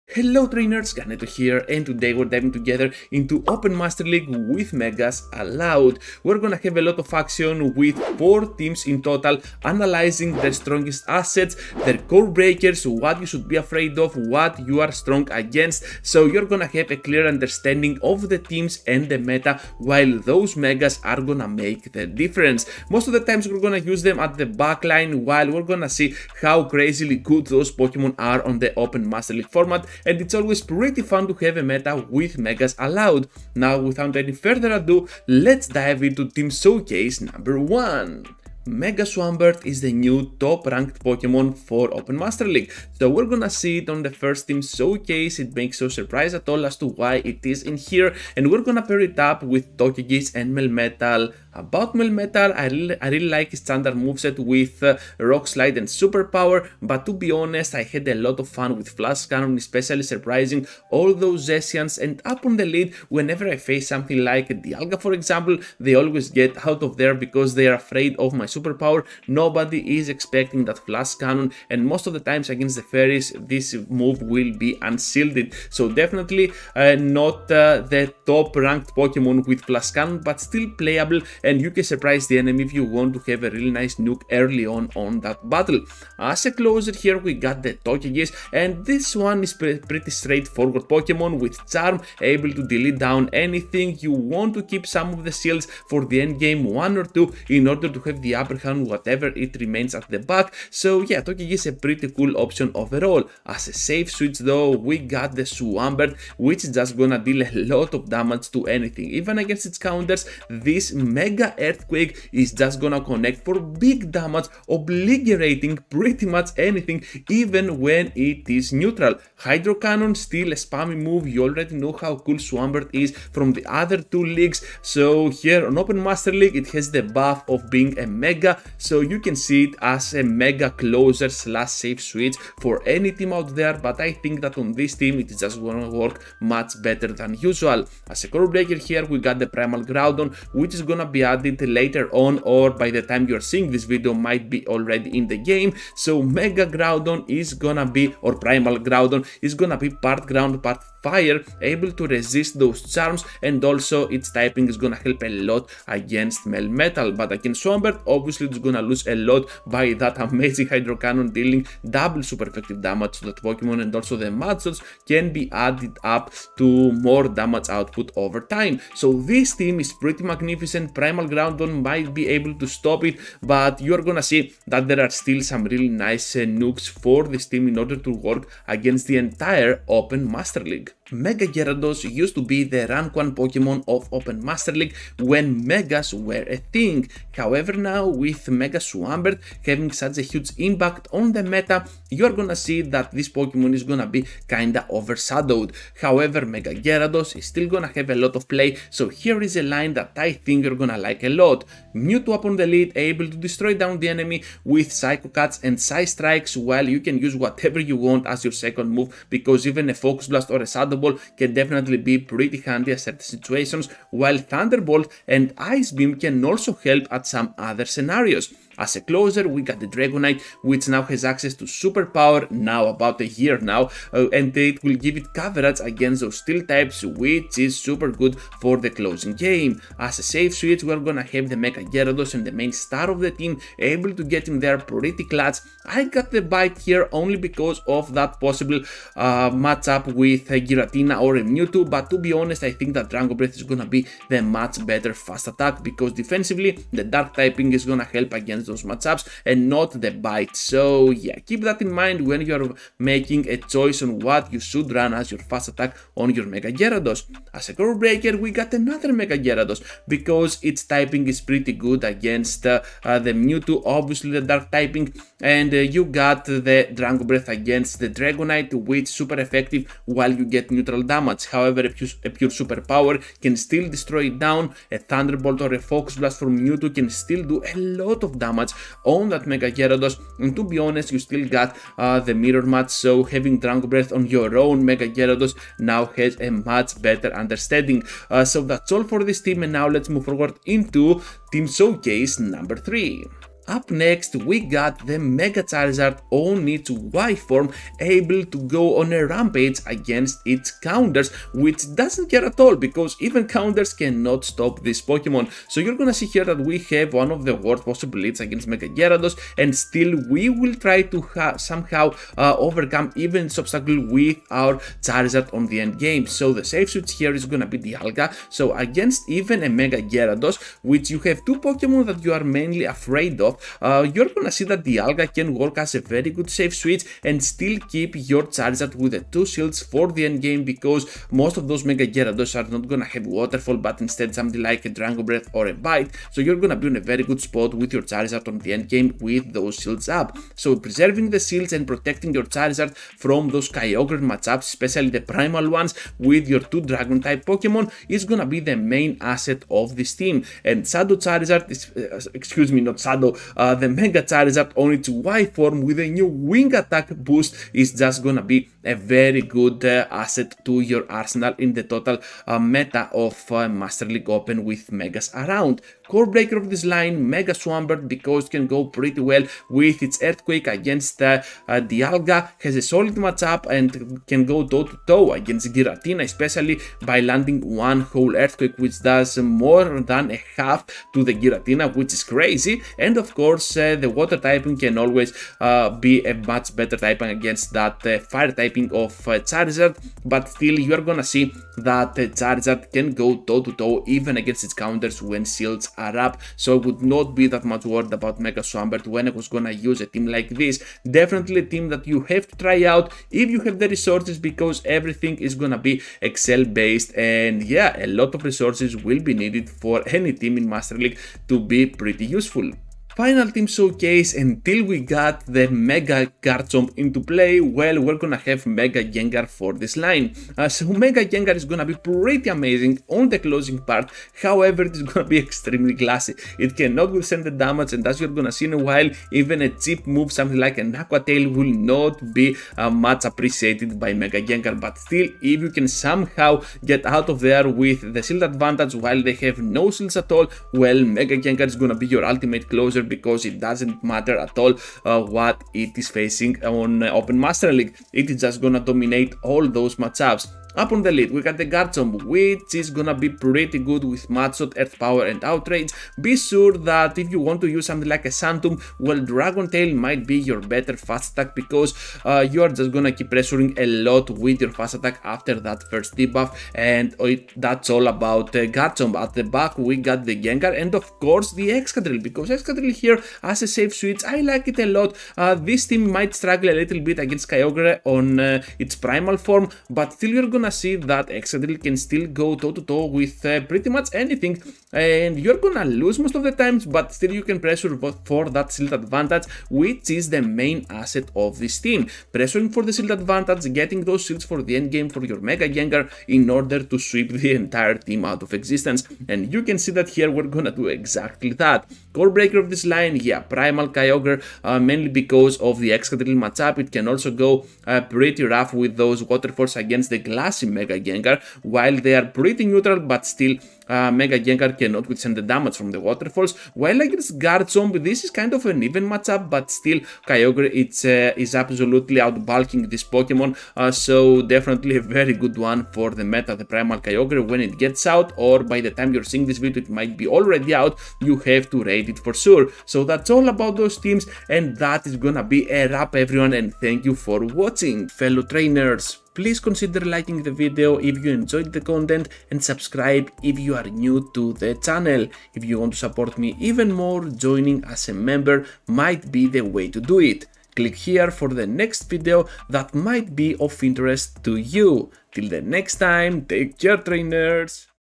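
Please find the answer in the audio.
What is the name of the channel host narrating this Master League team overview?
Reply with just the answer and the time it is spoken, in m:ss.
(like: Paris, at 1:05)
Ganeto, at 0:00.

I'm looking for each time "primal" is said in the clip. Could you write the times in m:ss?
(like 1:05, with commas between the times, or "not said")
2:19, 2:28, 2:50, 5:45, 7:58, 8:23, 8:46.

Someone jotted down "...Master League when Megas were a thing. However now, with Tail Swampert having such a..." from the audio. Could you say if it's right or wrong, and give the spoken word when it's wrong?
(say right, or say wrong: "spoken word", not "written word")
wrong: "Mega", not "Tail".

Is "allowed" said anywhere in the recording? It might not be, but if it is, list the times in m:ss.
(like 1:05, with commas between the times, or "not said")
0:05, 0:32.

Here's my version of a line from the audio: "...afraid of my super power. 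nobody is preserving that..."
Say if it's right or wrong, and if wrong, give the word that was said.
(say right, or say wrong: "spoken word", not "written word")
wrong: "expecting", not "preserving".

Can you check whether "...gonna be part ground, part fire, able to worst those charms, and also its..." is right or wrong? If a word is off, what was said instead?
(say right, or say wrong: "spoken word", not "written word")
wrong: "resist", not "worst".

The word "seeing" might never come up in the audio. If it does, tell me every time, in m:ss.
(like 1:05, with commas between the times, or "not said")
2:23, 8:49.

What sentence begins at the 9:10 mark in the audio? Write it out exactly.
Click here for the next video that might be of interest to you.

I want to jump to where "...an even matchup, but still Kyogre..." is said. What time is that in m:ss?
8:38.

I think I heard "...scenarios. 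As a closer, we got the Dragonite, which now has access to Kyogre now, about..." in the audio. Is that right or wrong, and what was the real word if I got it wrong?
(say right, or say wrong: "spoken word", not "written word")
wrong: "Superpower", not "Kyogre".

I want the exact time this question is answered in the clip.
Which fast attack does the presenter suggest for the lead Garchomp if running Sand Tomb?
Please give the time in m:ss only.
7:39.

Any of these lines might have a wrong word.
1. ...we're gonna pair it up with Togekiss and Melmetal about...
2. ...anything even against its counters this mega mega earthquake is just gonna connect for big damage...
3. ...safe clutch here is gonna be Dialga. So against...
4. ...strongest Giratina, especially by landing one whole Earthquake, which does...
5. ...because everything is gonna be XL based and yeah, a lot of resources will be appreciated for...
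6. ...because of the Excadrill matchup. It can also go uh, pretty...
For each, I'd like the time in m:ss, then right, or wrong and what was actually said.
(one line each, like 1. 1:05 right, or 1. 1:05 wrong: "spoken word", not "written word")
1. 0:48 right
2. 1:48 right
3. 5:16 wrong: "switch", not "clutch"
4. 6:15 wrong: "against", not "strongest"
5. 6:44 wrong: "needed", not "appreciated"
6. 8:25 right.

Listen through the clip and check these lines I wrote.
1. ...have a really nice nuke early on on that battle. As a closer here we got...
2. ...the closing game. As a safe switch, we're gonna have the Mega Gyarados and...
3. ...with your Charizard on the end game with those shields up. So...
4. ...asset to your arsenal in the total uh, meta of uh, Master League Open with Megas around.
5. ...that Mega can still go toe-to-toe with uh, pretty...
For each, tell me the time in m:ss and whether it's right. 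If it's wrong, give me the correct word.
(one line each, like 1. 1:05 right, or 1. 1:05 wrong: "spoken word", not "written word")
1. 1:23 right
2. 3:48 right
3. 5:37 right
4. 6:00 right
5. 8:01 wrong: "Excadrill", not "Mega".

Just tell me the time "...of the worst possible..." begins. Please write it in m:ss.
5:07.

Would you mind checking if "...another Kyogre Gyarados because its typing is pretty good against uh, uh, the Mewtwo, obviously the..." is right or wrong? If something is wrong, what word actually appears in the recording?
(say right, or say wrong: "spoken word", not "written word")
wrong: "Mega", not "Kyogre".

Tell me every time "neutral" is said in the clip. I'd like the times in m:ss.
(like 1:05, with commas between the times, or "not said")
1:58, 4:30, 8:32.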